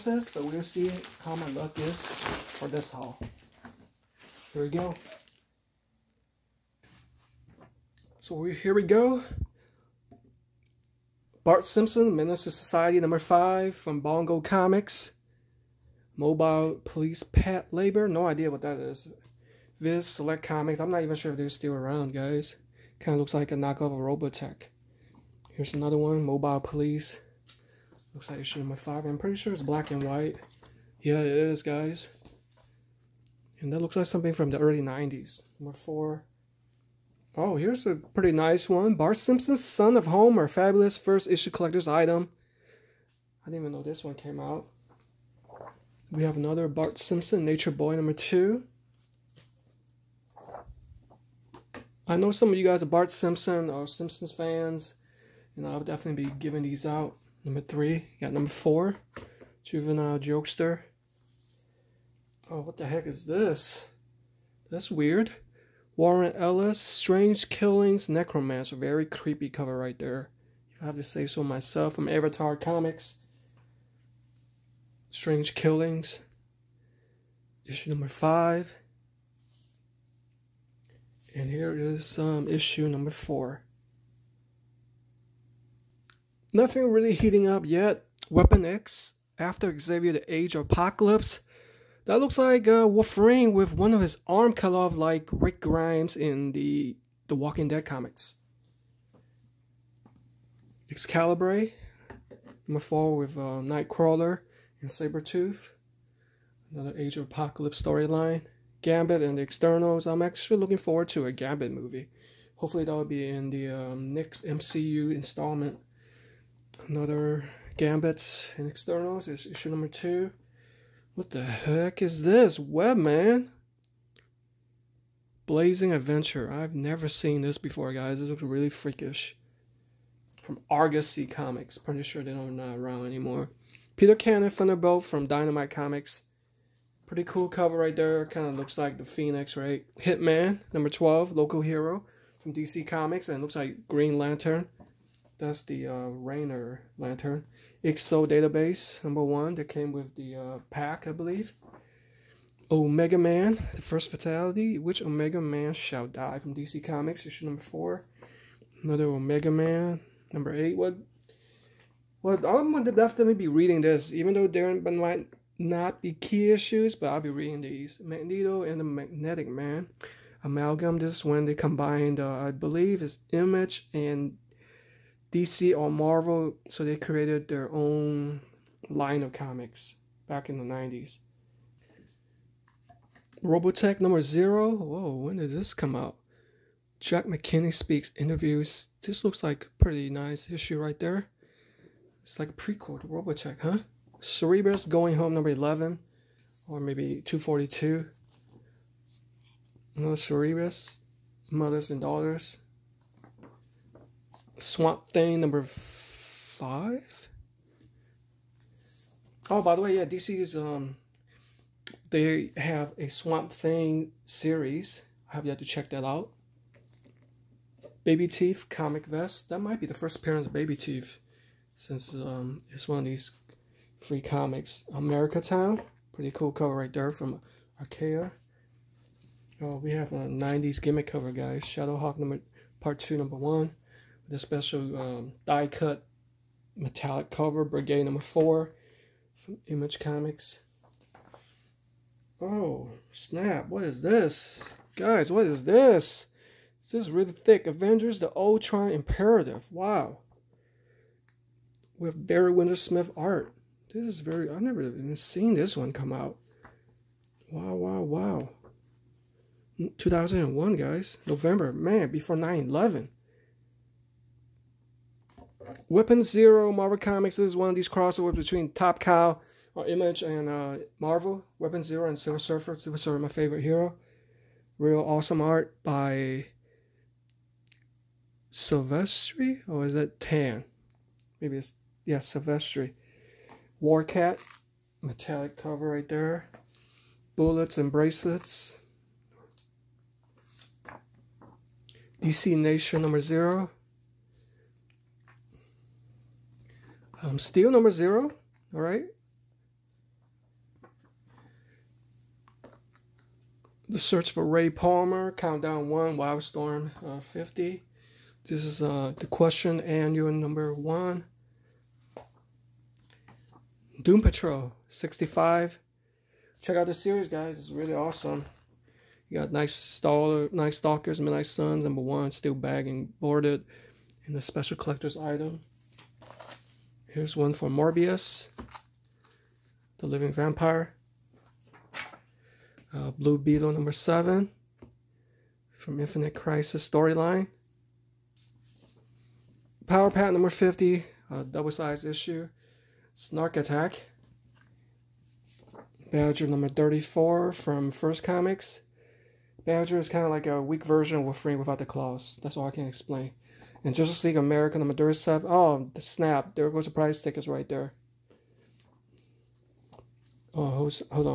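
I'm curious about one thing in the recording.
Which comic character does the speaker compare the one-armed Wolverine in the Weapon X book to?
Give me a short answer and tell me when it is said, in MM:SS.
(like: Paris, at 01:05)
Rick Grimes, at 01:35.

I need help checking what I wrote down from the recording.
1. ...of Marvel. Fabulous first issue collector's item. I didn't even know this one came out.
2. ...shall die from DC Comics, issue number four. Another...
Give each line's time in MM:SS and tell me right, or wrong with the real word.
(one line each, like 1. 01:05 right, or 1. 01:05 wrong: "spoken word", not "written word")
1. 00:39 wrong: "Homer", not "Marvel"
2. 02:35 right.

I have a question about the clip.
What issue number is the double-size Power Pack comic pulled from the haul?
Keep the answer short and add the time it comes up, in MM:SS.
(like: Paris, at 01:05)
50, at 05:40.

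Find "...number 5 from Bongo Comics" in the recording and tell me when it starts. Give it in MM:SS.
00:12.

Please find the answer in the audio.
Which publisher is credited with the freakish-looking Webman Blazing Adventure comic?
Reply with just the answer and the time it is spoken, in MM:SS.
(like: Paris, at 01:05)
Argosy Comics, at 02:10.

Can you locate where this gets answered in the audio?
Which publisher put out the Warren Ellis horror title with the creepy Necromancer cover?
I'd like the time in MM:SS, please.
01:12.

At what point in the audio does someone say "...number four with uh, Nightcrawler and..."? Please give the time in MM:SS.
01:42.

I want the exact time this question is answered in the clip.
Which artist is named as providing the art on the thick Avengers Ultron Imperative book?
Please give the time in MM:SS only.
04:12.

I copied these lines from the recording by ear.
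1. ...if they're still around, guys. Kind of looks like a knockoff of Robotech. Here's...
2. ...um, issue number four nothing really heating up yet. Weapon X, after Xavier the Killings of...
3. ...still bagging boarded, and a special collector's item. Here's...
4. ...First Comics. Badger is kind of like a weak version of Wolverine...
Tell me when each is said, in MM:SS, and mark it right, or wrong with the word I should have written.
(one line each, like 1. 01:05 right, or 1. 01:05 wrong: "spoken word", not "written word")
1. 00:21 right
2. 01:22 wrong: "Age", not "Killings"
3. 05:22 right
4. 05:47 right.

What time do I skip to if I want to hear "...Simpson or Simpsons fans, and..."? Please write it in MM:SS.
00:53.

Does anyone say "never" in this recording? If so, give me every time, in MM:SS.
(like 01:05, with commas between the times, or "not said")
02:06, 04:14.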